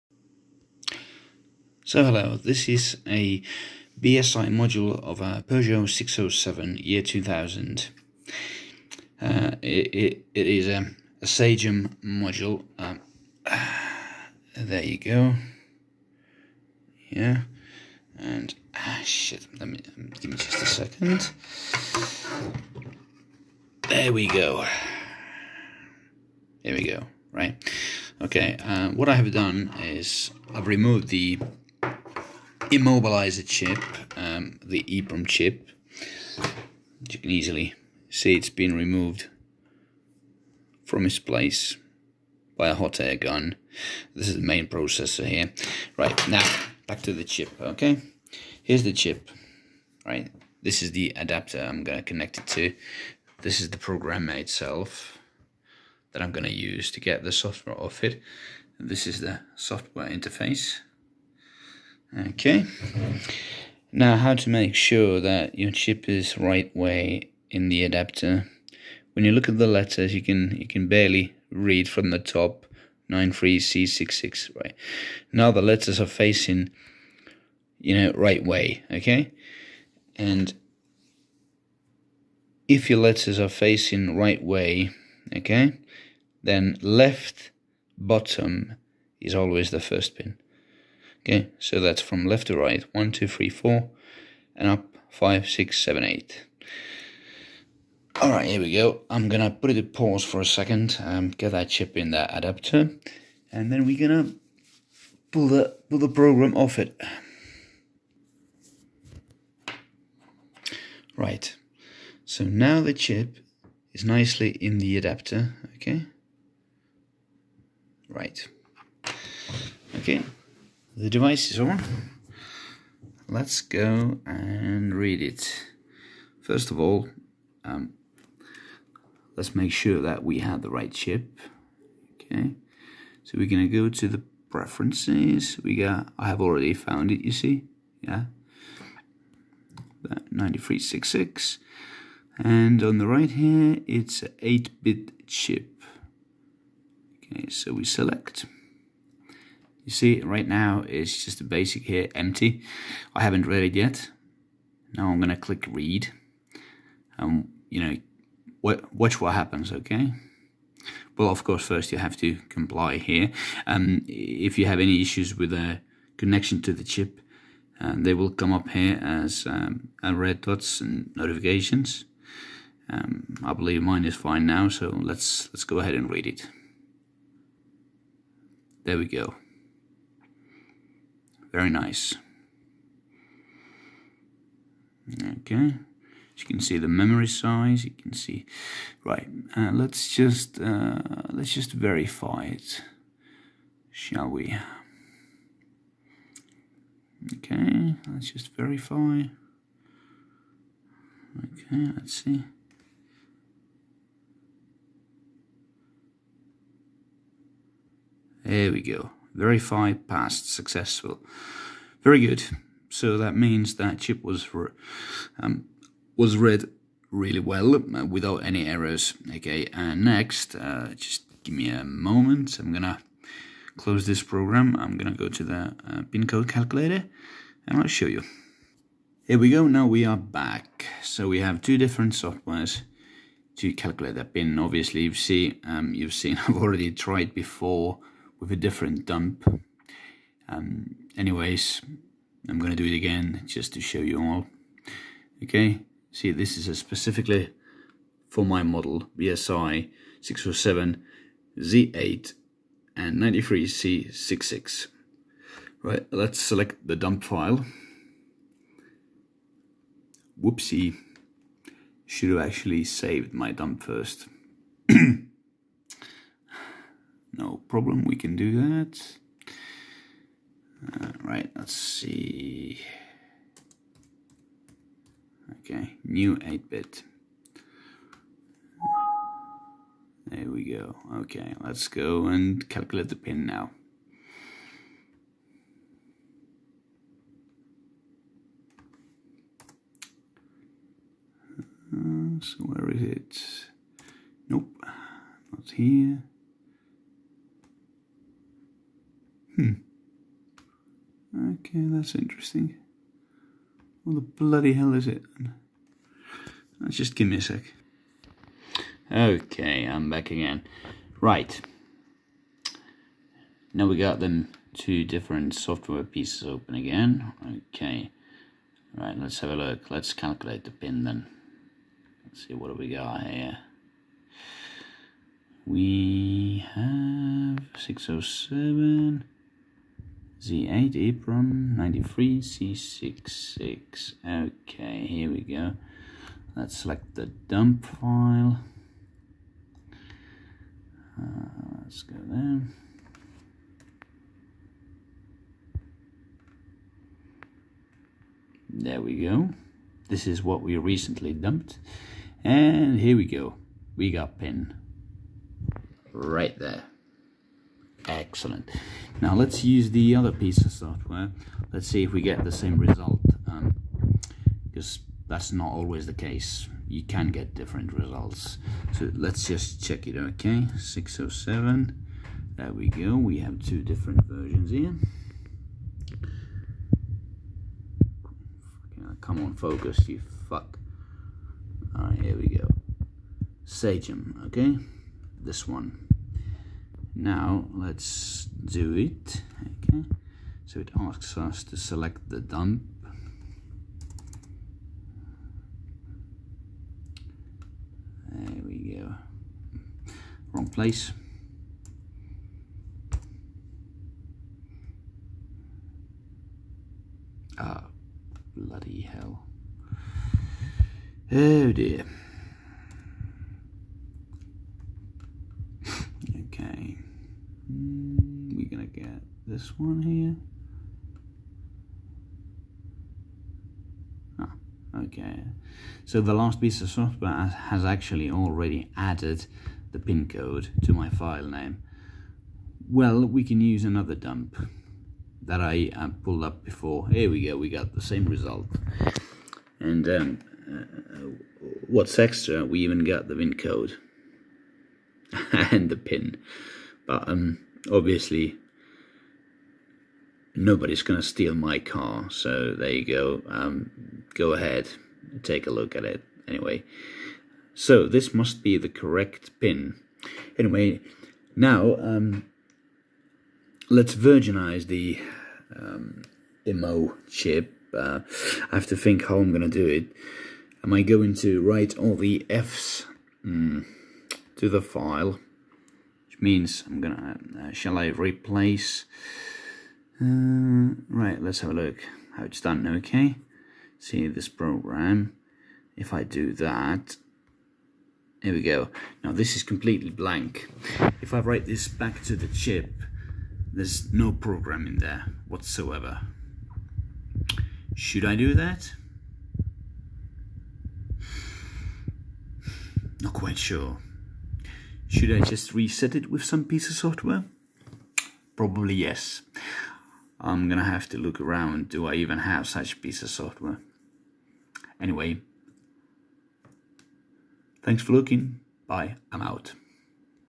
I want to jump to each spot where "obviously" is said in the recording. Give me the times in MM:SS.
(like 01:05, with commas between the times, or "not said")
03:54, 07:27.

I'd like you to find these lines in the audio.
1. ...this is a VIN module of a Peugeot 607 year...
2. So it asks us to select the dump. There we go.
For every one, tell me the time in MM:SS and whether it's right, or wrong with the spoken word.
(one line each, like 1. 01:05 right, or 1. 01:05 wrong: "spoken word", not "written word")
1. 00:02 wrong: "BSI", not "VIN"
2. 06:30 right.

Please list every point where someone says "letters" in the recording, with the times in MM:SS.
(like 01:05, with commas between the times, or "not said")
01:09, 01:15, 01:22.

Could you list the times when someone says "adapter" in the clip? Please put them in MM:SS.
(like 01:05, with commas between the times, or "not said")
00:51, 01:07, 01:42, 01:54.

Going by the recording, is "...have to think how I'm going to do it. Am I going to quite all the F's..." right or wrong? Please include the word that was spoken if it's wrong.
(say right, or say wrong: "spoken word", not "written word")
wrong: "write", not "quite".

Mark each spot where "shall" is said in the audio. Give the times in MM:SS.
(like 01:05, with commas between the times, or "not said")
03:13, 07:57.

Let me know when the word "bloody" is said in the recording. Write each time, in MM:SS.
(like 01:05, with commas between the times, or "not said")
05:04, 06:48.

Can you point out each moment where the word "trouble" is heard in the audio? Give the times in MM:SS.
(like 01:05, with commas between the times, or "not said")
not said.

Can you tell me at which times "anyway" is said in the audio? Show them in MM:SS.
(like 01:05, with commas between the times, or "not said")
04:01, 07:36, 07:40, 08:34.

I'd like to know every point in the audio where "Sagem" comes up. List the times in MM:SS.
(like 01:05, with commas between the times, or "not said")
00:11, 06:23.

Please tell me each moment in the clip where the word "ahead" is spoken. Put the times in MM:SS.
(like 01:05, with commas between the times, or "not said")
02:55, 07:34.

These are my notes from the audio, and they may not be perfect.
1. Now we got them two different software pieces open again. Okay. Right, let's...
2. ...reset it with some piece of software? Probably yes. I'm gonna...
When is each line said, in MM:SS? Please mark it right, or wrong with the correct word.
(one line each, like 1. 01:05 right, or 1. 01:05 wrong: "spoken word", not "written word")
1. 05:13 right
2. 08:25 right.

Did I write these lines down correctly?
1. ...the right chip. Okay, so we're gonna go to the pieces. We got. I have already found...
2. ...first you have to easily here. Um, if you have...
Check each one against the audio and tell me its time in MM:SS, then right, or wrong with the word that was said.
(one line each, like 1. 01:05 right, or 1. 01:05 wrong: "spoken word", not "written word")
1. 02:10 wrong: "preferences", not "pieces"
2. 02:41 wrong: "comply", not "easily".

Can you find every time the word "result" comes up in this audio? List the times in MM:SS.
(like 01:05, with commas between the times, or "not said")
06:02, 06:07, 07:18.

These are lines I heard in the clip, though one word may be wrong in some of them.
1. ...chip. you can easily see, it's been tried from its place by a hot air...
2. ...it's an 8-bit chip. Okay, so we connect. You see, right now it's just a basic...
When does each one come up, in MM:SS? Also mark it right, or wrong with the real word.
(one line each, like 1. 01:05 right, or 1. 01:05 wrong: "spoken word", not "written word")
1. 00:35 wrong: "removed", not "tried"
2. 02:23 wrong: "select", not "connect".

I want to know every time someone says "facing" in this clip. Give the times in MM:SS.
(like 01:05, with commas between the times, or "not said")
01:16, 01:23.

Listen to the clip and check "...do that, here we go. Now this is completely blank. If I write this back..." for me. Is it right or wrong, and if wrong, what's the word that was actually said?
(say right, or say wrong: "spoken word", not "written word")
right.